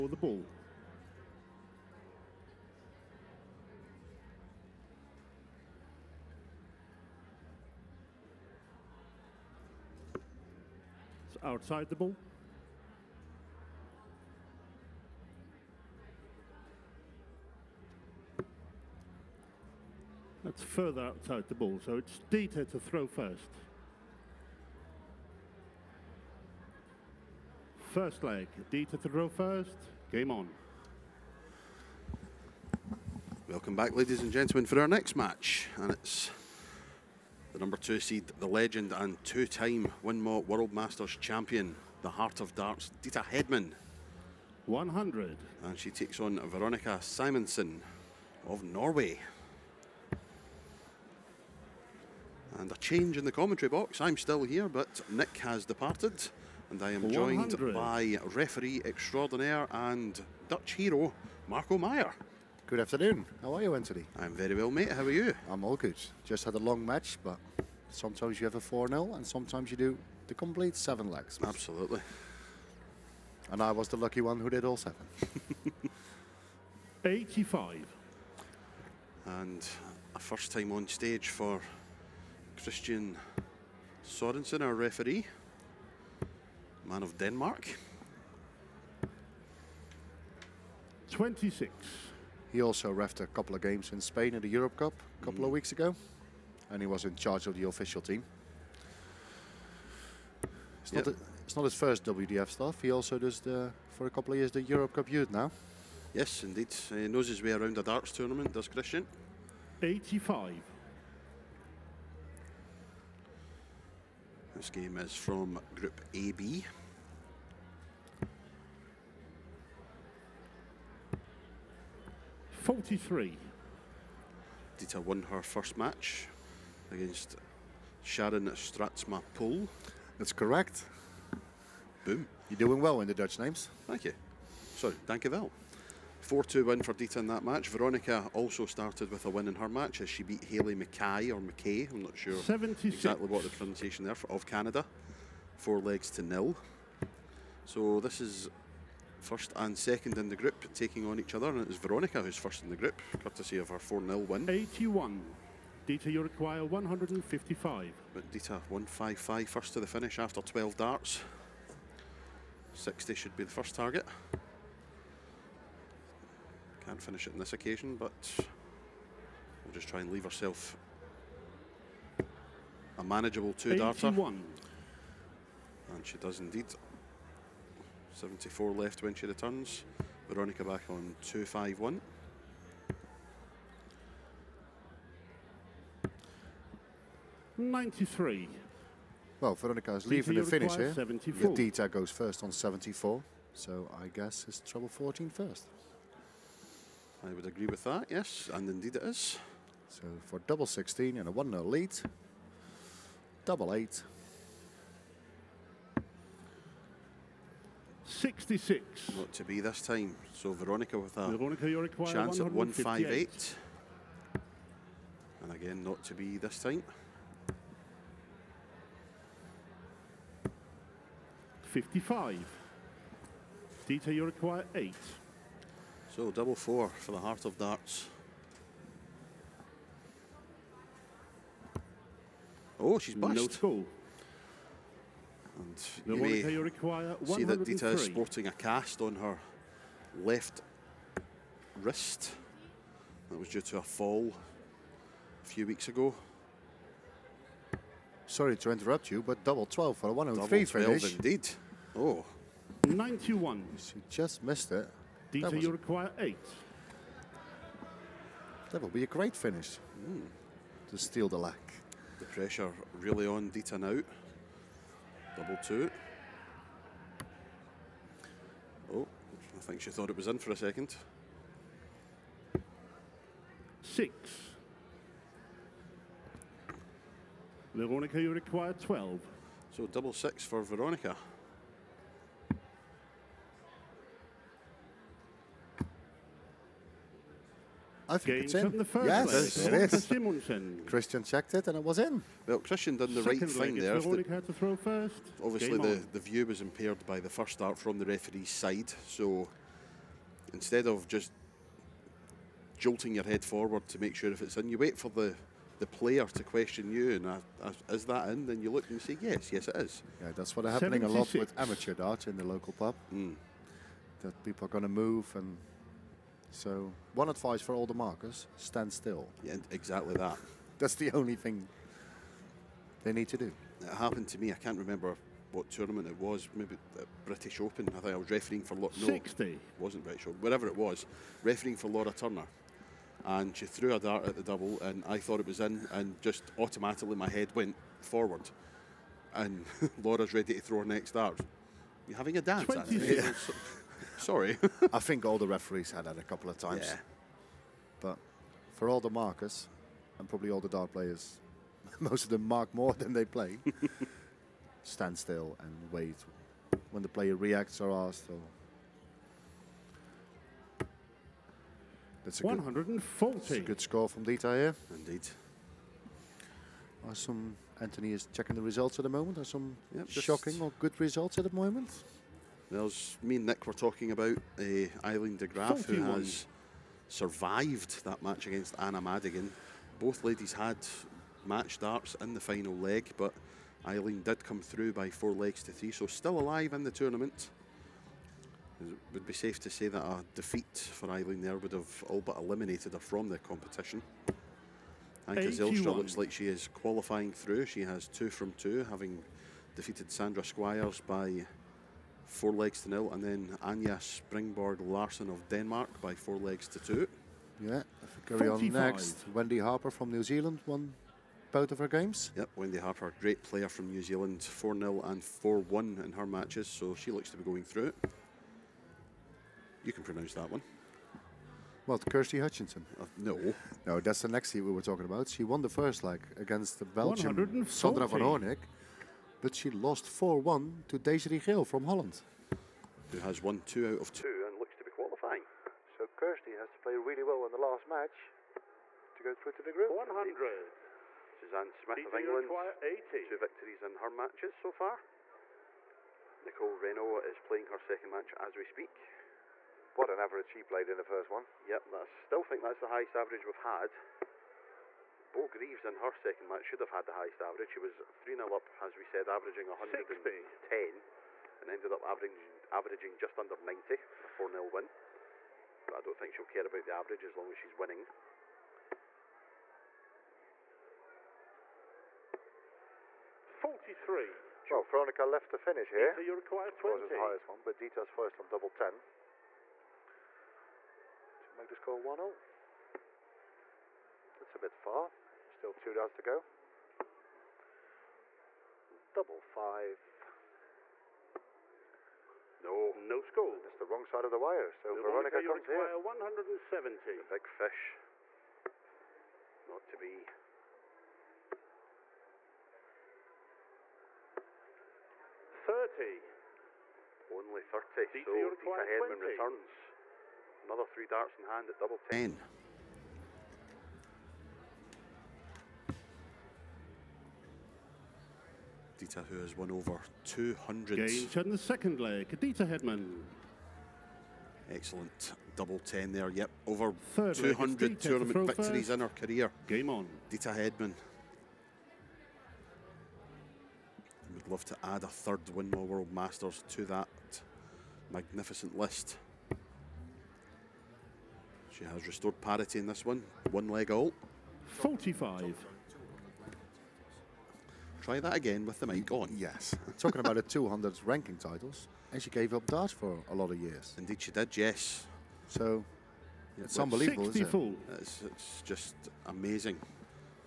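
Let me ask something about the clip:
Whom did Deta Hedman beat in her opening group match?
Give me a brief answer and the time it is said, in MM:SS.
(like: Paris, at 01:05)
Sharon Stratsma Pool, at 02:08.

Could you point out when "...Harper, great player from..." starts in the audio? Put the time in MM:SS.
06:52.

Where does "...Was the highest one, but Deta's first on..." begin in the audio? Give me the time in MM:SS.
07:56.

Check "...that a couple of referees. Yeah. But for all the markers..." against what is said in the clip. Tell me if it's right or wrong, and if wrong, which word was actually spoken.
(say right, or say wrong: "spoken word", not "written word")
wrong: "times", not "referees".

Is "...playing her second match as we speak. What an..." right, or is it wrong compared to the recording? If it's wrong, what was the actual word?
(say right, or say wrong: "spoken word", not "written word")
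right.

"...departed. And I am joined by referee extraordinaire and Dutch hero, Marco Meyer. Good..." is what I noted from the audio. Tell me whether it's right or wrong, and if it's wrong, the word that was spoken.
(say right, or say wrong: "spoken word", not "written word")
right.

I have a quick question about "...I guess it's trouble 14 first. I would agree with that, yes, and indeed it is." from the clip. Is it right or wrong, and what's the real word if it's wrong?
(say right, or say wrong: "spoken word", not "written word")
right.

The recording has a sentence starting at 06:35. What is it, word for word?
Anca Zijlstra looks like she is qualifying through.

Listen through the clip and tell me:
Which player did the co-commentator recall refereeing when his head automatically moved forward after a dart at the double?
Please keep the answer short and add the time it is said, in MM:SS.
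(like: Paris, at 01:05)
Laura Turner, at 05:31.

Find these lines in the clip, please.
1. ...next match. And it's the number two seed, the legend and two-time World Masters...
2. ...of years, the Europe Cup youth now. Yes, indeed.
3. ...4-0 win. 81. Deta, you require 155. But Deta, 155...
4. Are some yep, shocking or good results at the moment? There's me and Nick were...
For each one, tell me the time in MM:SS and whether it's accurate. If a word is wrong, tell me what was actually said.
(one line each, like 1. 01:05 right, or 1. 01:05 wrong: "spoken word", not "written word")
1. 00:34 right
2. 01:44 right
3. 02:33 right
4. 06:09 right.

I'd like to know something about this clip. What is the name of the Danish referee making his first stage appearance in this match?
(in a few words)
Christian Sorensen.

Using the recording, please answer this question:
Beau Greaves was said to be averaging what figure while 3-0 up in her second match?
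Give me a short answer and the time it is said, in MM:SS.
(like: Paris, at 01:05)
110, at 07:39.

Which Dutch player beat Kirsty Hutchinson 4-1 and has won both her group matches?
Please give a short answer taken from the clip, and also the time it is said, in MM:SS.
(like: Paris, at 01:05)
Desiree Gale, at 07:10.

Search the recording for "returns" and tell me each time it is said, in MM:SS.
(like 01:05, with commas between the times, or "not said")
02:59, 08:29.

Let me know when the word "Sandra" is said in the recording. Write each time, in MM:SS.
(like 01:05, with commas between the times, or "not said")
06:40, 07:07.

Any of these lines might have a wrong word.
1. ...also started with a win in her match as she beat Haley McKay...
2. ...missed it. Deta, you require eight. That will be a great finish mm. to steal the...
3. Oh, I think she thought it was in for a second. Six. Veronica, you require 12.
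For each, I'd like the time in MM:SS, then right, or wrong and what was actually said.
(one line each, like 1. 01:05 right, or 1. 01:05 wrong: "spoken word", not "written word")
1. 02:18 right
2. 04:14 right
3. 04:28 right.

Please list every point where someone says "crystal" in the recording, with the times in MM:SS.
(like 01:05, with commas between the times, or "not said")
not said.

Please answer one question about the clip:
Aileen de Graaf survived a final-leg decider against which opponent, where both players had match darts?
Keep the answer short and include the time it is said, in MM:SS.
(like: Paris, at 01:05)
Anna Madigan, at 06:18.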